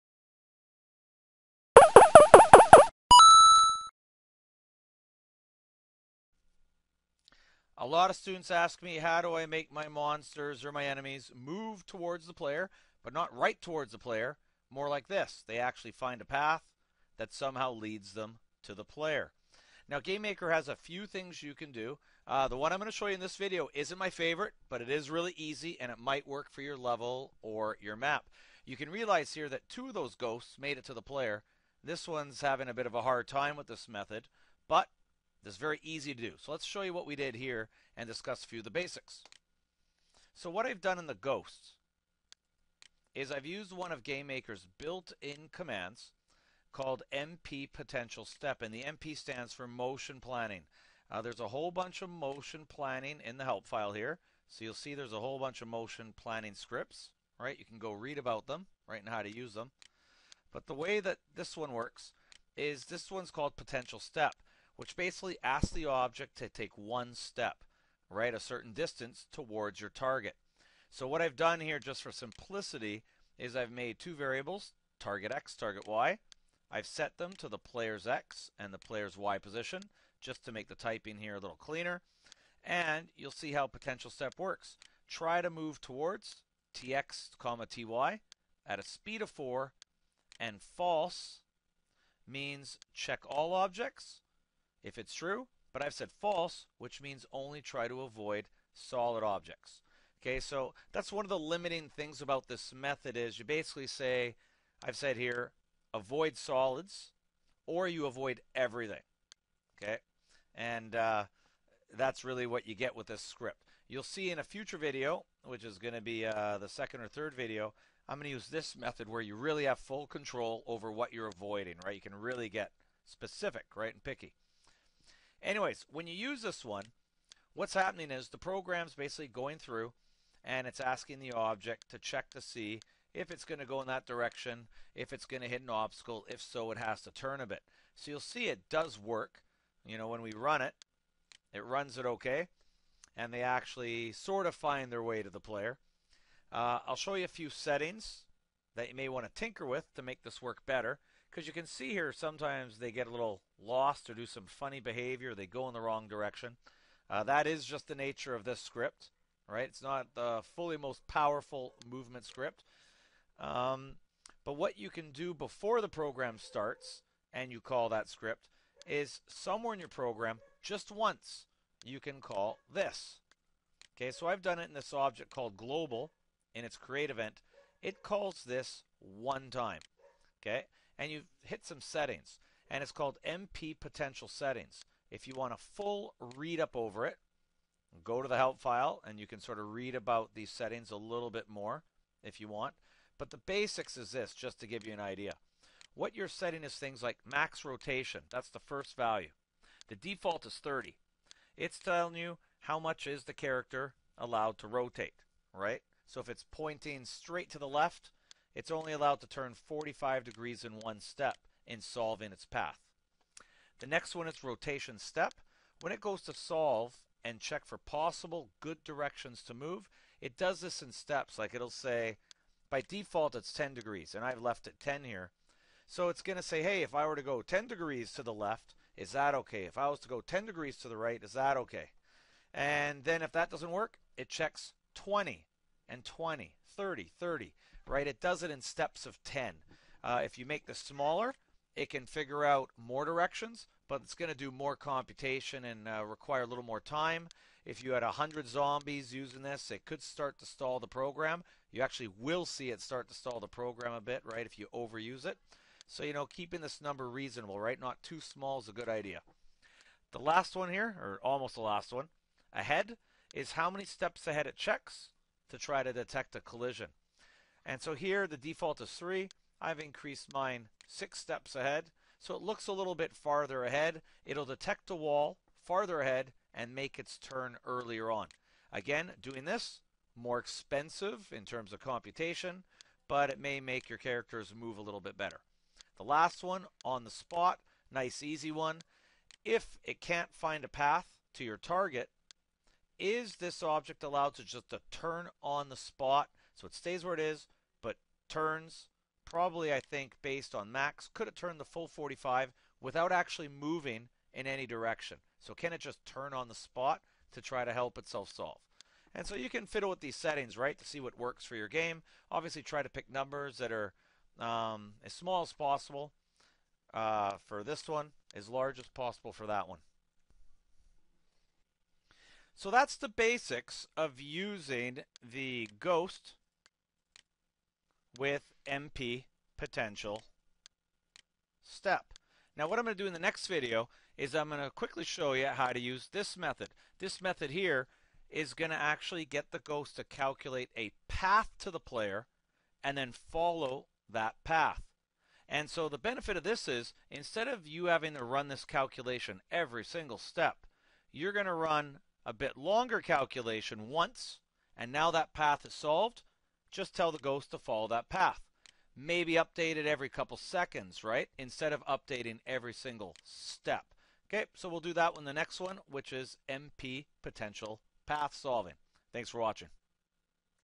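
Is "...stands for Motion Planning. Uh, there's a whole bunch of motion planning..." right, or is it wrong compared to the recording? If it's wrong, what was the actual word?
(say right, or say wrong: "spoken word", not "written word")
right.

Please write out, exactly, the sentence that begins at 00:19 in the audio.
Now, Game Maker has a few things you can do.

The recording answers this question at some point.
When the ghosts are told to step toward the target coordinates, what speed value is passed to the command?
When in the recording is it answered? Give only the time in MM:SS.
01:28.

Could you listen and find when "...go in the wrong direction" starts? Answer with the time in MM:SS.
02:35.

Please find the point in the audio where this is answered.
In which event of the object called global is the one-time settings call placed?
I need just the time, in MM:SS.
02:56.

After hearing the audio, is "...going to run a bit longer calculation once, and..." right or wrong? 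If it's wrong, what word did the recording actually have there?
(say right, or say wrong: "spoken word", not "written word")
right.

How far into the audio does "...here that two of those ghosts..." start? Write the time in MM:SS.
00:29.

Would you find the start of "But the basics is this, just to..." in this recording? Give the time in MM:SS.
03:13.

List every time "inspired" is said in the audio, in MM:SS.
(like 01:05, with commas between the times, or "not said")
not said.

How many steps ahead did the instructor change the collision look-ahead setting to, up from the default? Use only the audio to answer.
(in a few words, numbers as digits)
6.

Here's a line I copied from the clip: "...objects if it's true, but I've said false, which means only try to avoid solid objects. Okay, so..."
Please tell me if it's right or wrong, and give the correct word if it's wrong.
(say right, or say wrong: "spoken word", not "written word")
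right.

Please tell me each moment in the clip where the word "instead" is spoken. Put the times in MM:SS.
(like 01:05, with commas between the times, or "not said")
05:47, 06:01.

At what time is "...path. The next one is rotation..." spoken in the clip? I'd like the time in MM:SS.
03:32.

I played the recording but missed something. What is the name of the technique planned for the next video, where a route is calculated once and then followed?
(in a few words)
MP potential path solving.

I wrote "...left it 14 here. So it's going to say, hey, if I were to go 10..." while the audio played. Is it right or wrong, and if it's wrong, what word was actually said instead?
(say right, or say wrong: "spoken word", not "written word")
wrong: "10", not "14".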